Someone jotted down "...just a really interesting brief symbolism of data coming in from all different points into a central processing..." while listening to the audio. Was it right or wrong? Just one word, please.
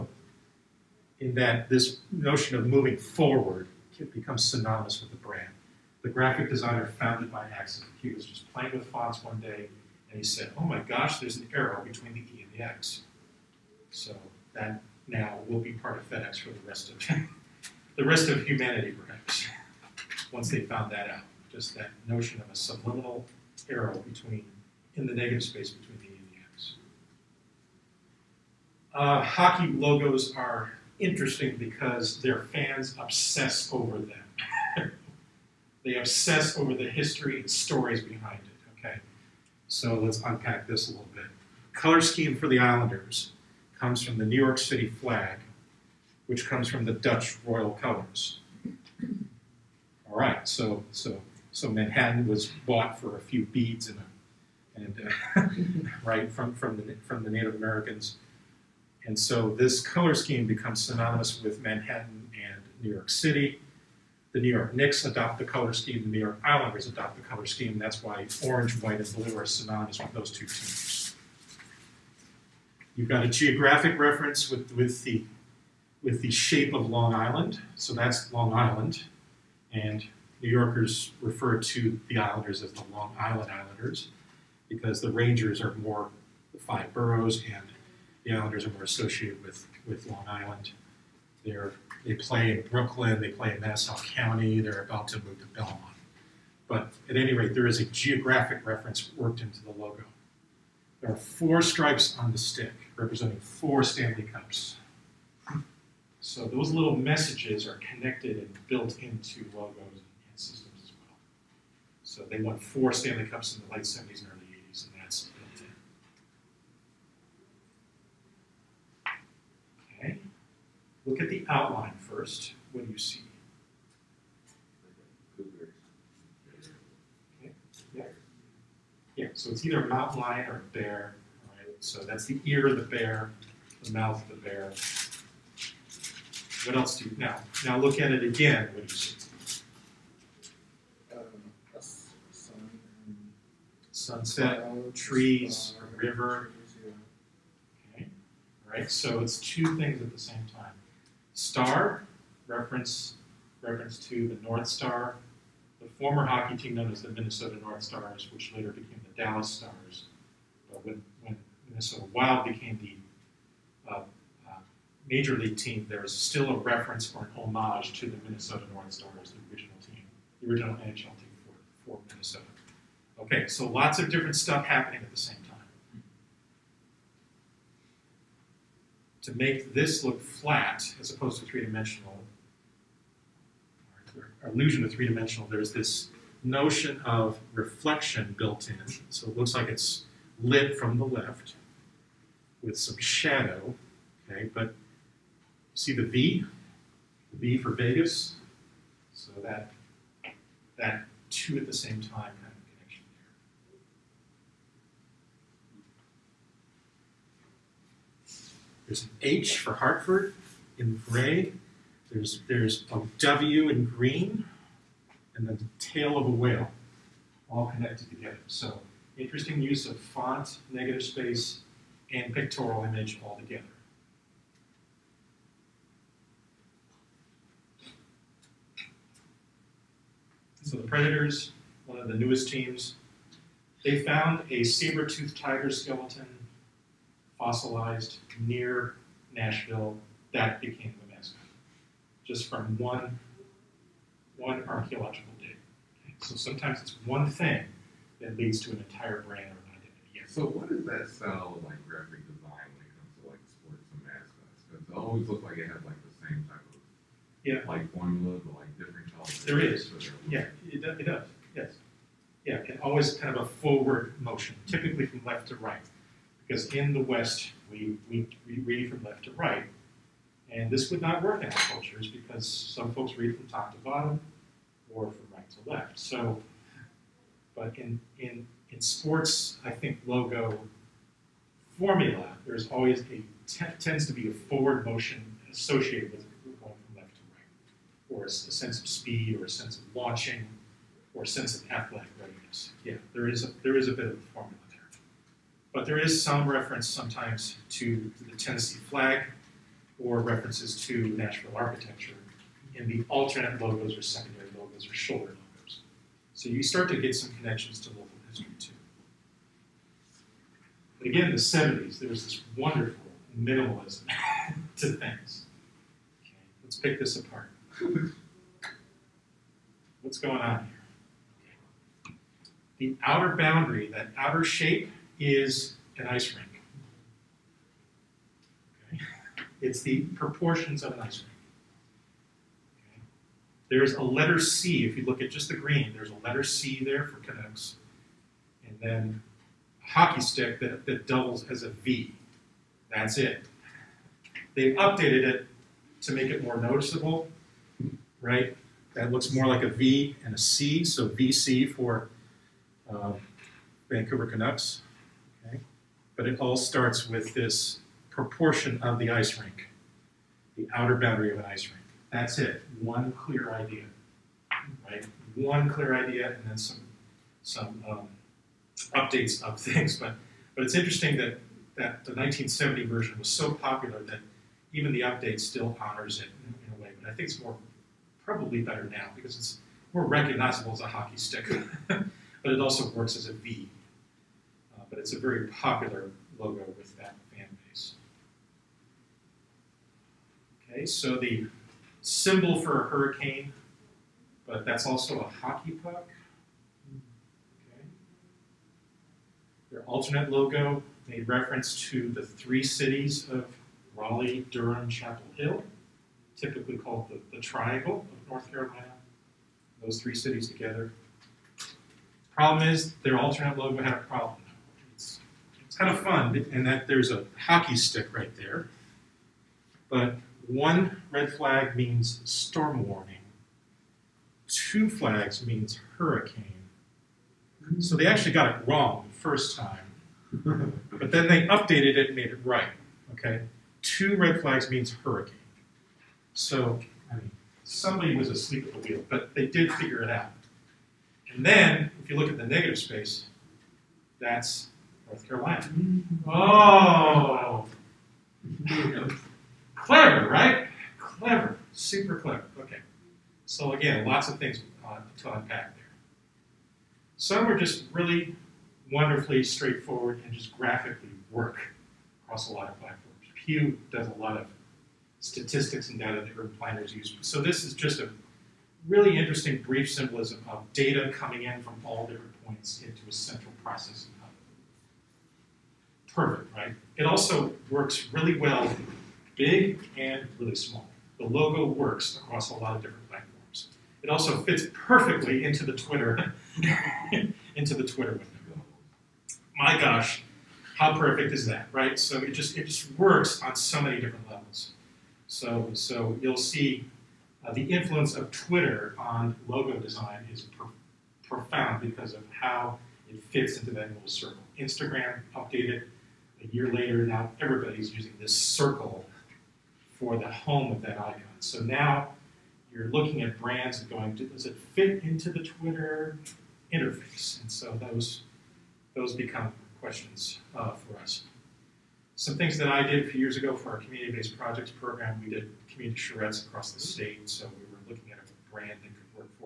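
right.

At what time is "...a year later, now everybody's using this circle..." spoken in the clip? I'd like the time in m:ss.
8:26.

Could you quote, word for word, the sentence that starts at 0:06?
The graphic designer found it by accident.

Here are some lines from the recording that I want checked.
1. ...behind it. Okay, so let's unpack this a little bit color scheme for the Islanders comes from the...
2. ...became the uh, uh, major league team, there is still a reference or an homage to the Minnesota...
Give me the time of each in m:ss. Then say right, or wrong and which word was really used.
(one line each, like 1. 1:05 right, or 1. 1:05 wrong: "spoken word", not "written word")
1. 0:38 right
2. 2:42 right.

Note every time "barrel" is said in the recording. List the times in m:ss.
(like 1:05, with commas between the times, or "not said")
not said.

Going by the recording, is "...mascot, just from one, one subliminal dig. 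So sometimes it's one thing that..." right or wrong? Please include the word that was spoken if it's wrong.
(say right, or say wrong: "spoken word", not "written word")
wrong: "archaeological", not "subliminal".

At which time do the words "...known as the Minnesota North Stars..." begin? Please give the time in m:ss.
2:36.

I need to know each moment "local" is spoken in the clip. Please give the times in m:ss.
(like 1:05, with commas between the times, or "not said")
5:07.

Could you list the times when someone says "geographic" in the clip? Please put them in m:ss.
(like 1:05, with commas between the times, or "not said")
1:13, 1:37.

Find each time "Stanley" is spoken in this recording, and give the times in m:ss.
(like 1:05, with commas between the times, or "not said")
1:43, 1:52.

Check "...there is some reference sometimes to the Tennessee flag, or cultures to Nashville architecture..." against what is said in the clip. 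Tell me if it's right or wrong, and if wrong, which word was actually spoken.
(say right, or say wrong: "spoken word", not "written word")
wrong: "references", not "cultures".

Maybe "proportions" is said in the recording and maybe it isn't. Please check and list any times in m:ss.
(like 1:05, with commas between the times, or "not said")
5:30, 5:58.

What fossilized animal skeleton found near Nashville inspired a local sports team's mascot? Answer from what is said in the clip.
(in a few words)
saber-toothed tiger.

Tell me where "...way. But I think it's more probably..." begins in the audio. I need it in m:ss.
6:16.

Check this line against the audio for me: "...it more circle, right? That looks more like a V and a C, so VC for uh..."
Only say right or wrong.
wrong.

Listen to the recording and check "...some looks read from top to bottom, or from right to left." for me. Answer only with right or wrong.
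wrong.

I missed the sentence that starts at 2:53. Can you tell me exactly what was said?
Okay, so lots of different stuff happening at the same time.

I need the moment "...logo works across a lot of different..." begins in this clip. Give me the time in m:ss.
8:01.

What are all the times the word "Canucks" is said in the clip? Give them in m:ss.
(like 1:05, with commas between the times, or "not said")
5:37, 5:54.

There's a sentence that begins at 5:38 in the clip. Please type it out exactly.
And then a hockey stick that, that doubles as a V.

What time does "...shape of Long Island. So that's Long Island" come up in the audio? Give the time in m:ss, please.
1:16.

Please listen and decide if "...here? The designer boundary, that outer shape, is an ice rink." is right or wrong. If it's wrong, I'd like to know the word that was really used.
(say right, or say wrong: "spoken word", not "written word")
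wrong: "outer", not "designer".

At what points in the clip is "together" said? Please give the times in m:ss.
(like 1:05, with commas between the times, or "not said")
3:38, 3:43, 6:50.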